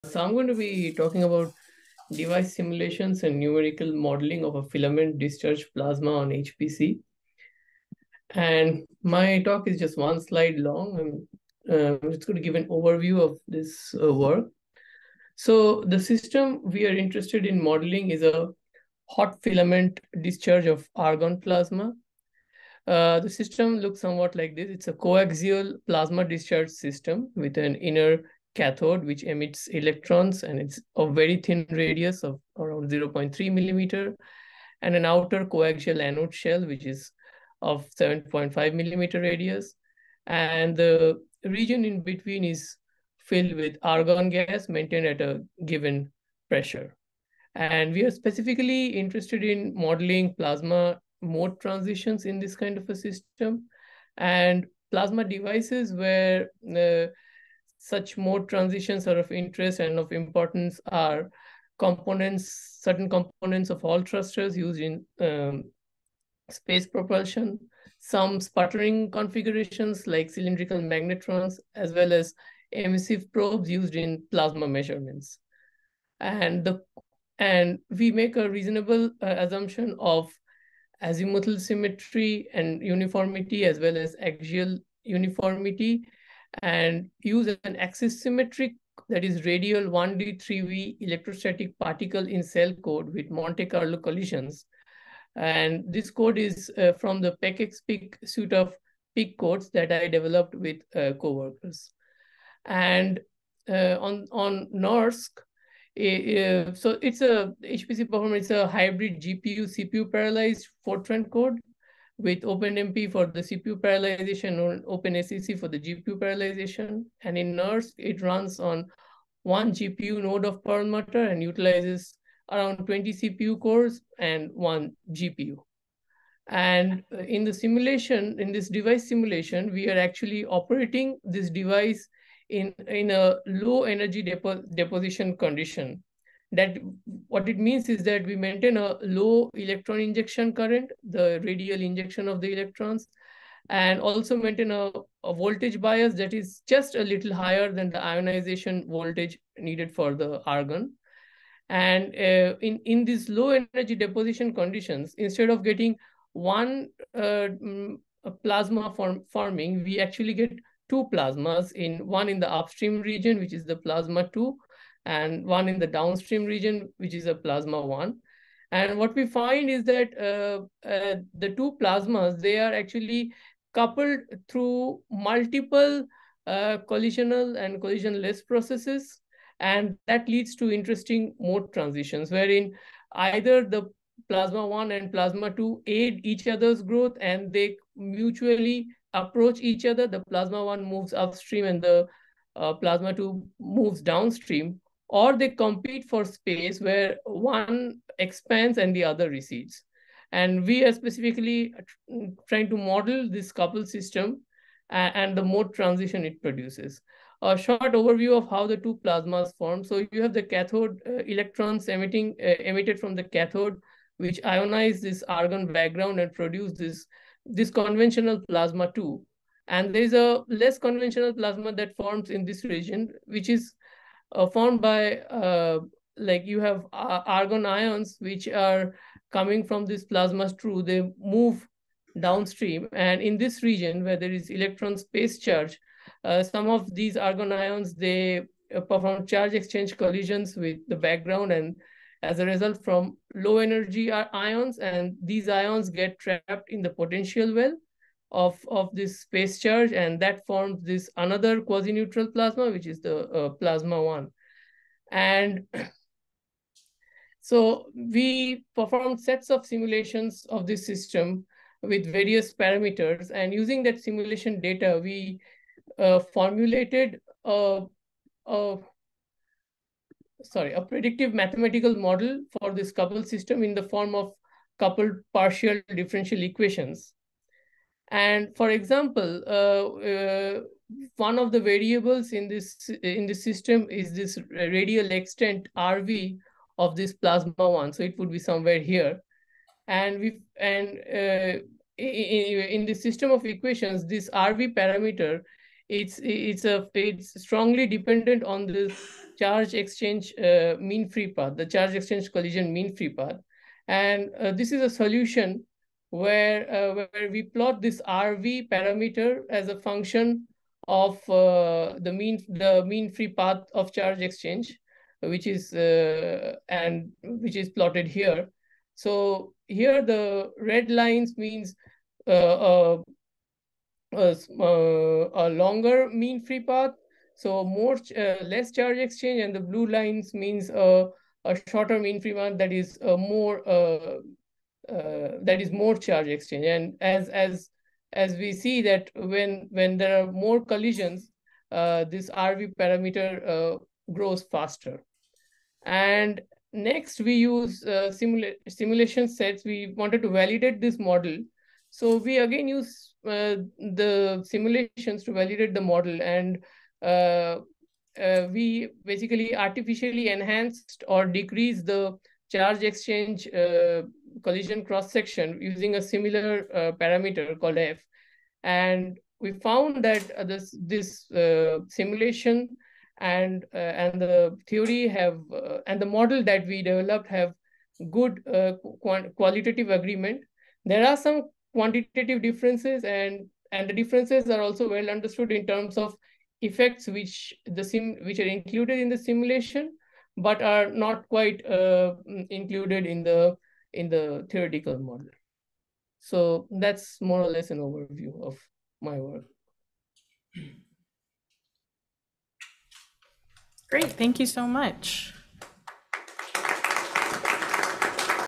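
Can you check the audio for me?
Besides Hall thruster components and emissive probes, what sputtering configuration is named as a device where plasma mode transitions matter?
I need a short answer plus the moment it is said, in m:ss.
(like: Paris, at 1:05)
Cylindrical magnetrons, at 1:10.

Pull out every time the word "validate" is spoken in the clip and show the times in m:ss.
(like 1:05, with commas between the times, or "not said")
5:50, 5:55.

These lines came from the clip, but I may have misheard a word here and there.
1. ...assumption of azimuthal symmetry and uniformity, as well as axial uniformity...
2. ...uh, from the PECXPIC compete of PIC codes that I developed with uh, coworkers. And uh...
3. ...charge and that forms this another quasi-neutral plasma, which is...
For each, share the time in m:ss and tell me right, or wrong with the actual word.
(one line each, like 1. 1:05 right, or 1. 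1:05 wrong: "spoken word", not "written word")
1. 1:19 right
2. 1:36 wrong: "suite", not "compete"
3. 4:09 right.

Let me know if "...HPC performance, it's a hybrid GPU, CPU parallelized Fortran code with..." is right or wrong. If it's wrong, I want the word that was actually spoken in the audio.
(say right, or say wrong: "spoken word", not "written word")
right.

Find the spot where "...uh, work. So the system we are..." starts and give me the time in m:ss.
0:14.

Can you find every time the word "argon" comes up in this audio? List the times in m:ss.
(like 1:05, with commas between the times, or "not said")
0:20, 0:43, 2:30, 3:35, 3:47, 3:57.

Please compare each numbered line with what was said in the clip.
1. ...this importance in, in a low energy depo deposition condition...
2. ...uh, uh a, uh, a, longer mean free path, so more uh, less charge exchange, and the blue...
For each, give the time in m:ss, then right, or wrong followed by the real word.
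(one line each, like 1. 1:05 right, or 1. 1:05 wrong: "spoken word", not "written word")
1. 2:11 wrong: "device", not "importance"
2. 5:22 right.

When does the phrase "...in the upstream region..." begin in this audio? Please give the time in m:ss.
2:42.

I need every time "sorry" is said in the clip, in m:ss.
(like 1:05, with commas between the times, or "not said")
4:30.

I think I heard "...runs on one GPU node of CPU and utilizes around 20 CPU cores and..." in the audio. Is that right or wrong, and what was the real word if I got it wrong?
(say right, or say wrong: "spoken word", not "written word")
wrong: "Perlmutter", not "CPU".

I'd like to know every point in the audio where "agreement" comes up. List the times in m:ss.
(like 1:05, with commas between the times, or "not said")
6:19.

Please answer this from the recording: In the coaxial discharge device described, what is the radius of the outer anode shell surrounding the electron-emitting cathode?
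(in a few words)
7.5 millimeters.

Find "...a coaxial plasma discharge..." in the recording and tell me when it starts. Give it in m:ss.
0:24.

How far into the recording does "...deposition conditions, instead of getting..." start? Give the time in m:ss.
2:33.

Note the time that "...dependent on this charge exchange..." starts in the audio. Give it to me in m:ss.
4:57.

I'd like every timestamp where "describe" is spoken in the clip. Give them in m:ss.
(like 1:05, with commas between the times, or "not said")
not said.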